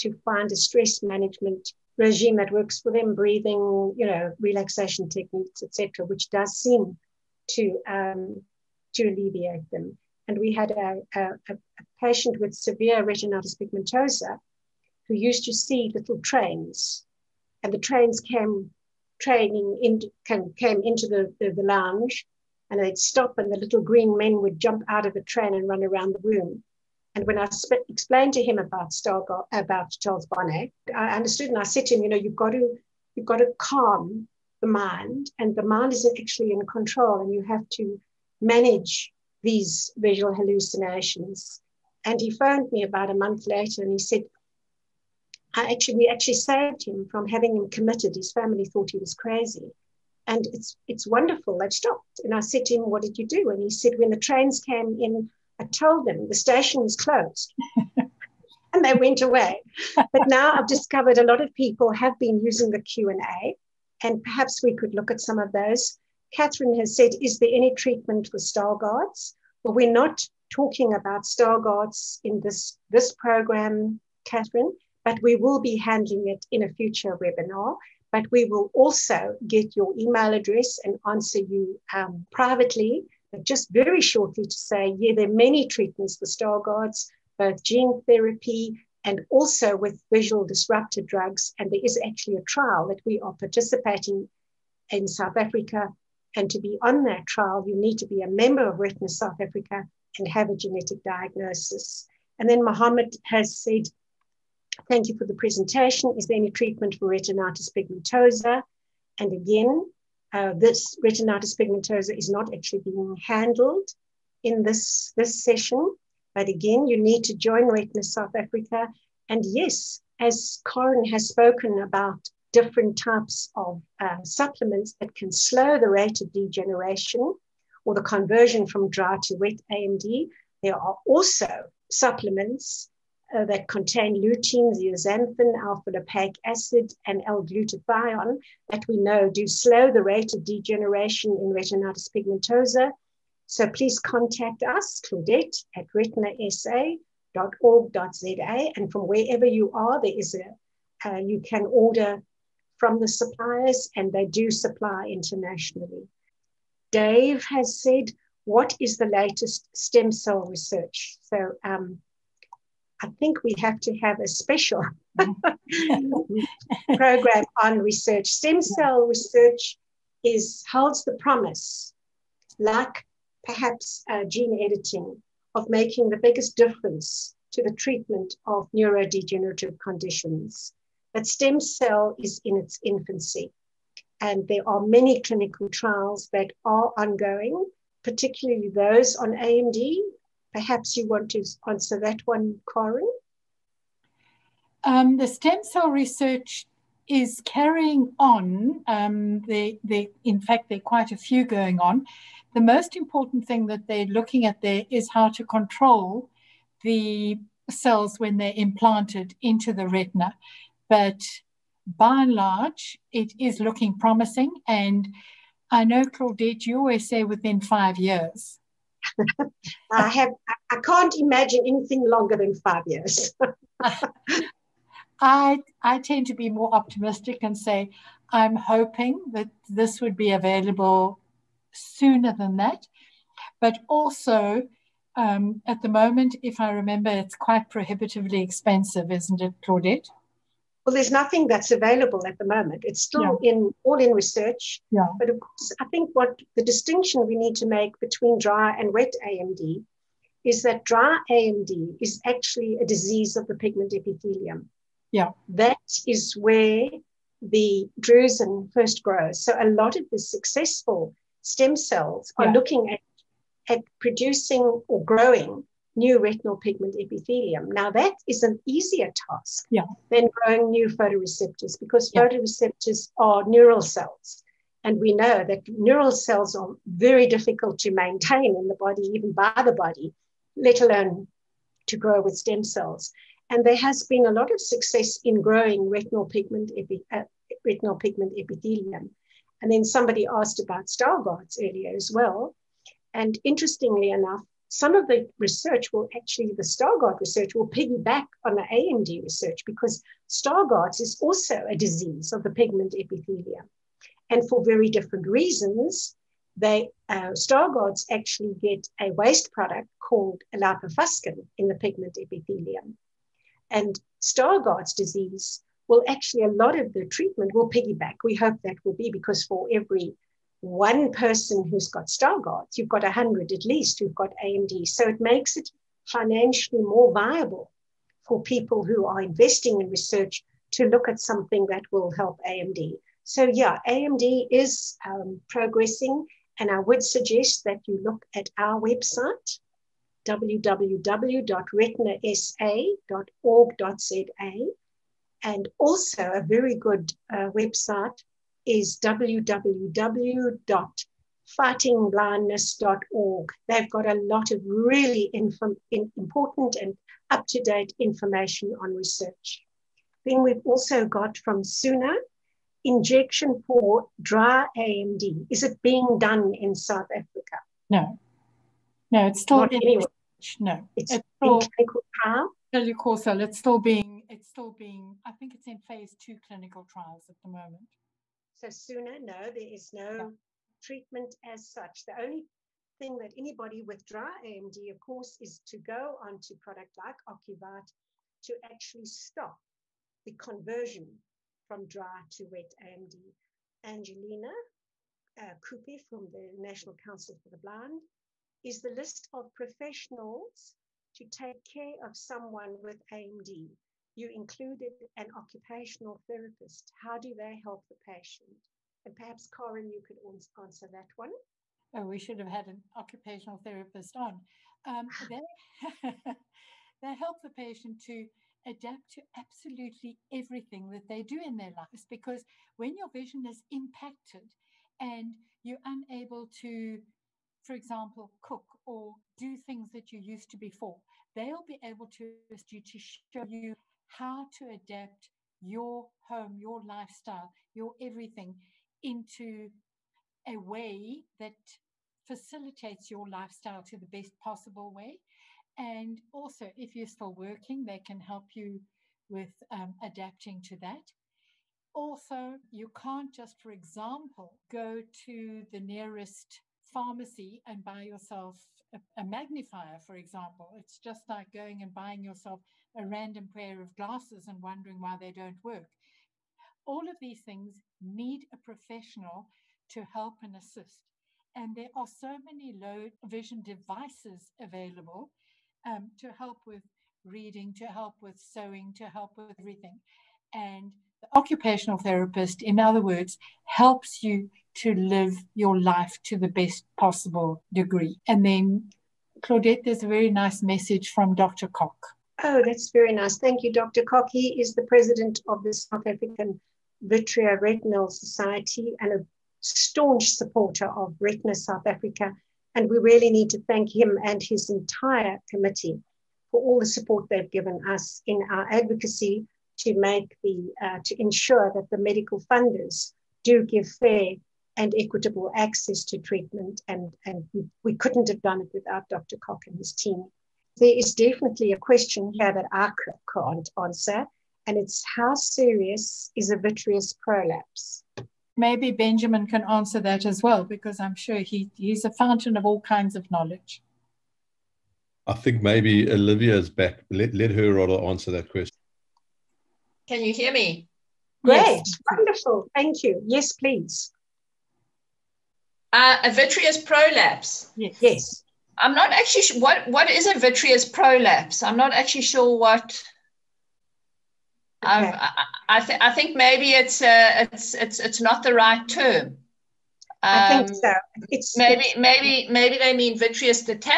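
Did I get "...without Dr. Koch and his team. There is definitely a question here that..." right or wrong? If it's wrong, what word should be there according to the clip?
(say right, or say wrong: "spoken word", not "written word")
right.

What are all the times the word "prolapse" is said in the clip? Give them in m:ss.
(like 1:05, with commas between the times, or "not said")
8:47, 9:06, 9:10.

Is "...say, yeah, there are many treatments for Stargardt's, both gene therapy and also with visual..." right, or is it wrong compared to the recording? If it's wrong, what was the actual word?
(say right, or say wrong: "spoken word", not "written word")
right.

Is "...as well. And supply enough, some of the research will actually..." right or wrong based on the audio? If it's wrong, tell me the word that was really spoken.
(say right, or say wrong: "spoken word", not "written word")
wrong: "interestingly", not "supply".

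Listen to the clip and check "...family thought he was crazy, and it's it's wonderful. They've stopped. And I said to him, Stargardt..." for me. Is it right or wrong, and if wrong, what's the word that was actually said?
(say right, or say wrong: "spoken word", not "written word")
wrong: "What", not "Stargardt".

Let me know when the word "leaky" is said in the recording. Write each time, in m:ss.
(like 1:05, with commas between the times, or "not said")
not said.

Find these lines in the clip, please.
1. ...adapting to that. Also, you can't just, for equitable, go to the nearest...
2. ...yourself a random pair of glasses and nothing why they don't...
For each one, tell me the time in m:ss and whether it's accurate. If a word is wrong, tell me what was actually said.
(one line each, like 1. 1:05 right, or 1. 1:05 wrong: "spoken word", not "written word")
1. 7:30 wrong: "example", not "equitable"
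2. 7:42 wrong: "wondering", not "nothing".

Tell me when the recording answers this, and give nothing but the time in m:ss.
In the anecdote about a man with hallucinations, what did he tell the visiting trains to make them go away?
0:56.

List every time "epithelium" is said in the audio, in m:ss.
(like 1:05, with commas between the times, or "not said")
4:13, 4:26, 4:48, 5:02, 5:12.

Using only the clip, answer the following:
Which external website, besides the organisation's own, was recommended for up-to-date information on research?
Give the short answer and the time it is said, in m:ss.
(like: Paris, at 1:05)
www.fightingblindness.org, at 5:49.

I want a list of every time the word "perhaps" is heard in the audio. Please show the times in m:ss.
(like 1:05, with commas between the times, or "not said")
1:04, 2:53, 3:10, 6:49.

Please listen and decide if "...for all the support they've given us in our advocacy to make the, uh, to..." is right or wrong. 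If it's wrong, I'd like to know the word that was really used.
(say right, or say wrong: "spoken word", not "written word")
right.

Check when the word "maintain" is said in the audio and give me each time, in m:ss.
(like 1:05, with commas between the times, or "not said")
4:37.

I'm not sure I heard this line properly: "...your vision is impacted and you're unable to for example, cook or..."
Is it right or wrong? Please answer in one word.
right.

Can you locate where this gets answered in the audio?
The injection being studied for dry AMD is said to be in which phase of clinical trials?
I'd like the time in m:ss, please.
6:15.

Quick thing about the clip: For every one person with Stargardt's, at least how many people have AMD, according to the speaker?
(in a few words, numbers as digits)
100.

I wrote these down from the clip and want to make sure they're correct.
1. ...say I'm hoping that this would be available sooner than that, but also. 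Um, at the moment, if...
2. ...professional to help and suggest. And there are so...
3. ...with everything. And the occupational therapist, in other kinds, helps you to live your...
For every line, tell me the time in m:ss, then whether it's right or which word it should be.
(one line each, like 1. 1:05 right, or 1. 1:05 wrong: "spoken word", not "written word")
1. 3:47 right
2. 7:48 wrong: "assist", not "suggest"
3. 7:59 wrong: "words", not "kinds".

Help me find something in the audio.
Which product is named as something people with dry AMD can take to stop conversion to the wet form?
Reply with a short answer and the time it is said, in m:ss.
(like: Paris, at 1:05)
Ocuvite, at 6:27.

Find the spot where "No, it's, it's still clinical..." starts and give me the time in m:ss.
6:10.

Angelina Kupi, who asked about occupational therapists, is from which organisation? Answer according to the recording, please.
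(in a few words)
National Council for the Blind.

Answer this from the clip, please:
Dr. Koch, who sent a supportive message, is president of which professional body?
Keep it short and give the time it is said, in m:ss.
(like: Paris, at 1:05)
South African Vitreoretinal Society, at 8:15.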